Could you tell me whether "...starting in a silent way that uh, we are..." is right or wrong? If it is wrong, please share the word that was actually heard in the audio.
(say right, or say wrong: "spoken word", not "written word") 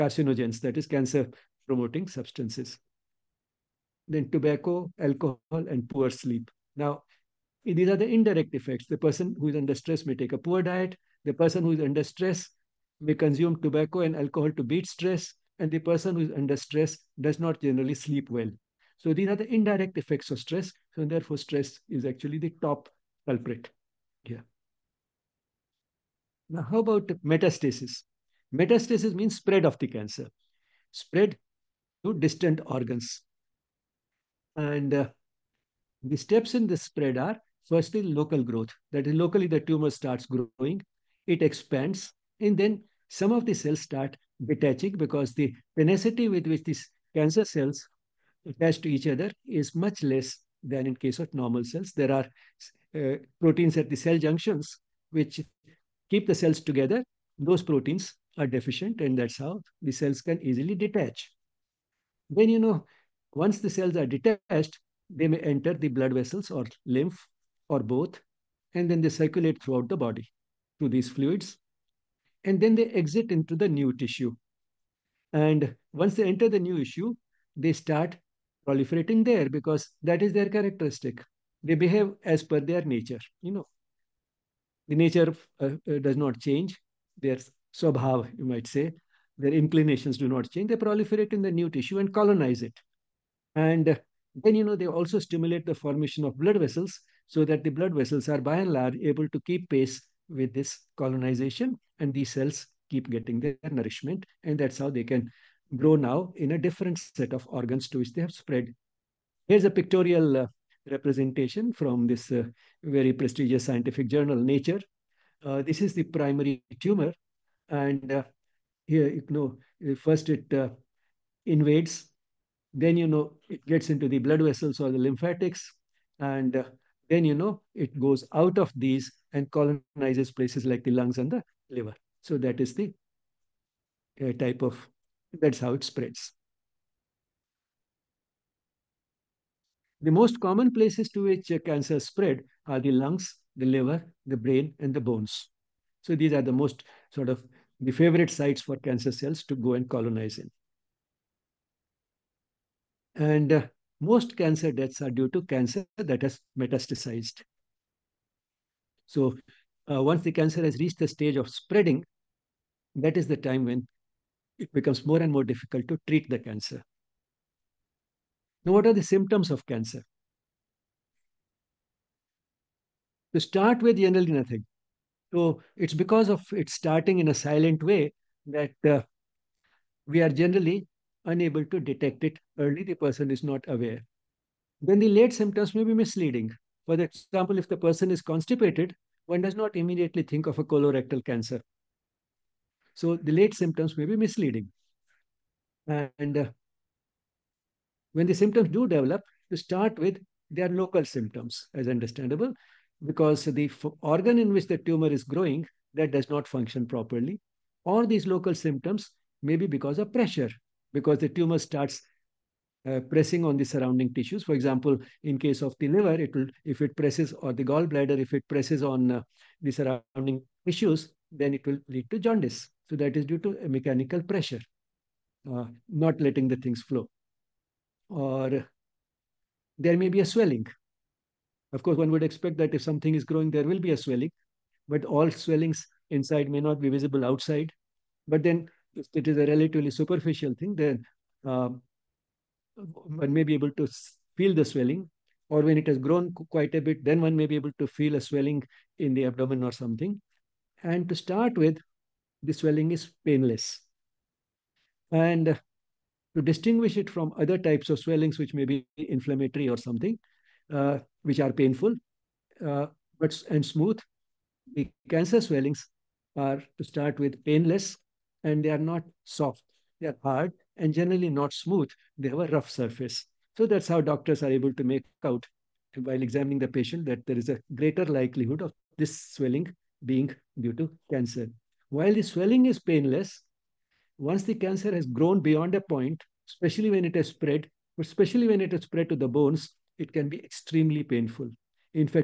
right.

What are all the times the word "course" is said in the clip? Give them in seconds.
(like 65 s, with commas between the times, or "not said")
231 s.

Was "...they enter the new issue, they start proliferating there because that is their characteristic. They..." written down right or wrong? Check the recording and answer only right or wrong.
right.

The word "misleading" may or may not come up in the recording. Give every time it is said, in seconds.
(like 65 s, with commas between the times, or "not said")
185 s, 194 s.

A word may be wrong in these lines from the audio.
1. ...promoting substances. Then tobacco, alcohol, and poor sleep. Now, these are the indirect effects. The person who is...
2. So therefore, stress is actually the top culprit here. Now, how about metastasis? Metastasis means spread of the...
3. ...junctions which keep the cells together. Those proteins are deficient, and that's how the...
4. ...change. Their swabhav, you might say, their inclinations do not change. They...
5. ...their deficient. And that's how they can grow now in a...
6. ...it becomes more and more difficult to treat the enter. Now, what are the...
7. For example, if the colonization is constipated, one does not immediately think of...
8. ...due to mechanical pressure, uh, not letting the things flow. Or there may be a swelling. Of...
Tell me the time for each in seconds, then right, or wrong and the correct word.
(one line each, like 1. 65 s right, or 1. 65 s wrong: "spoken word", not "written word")
1. 1 s right
2. 20 s right
3. 54 s right
4. 86 s right
5. 103 s wrong: "nourishment", not "deficient"
6. 164 s wrong: "cancer", not "enter"
7. 186 s wrong: "person", not "colonization"
8. 223 s right.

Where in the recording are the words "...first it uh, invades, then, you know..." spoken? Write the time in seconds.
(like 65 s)
119 s.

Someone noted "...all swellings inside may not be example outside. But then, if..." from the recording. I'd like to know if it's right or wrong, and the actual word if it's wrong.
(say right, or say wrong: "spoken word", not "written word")
wrong: "visible", not "example".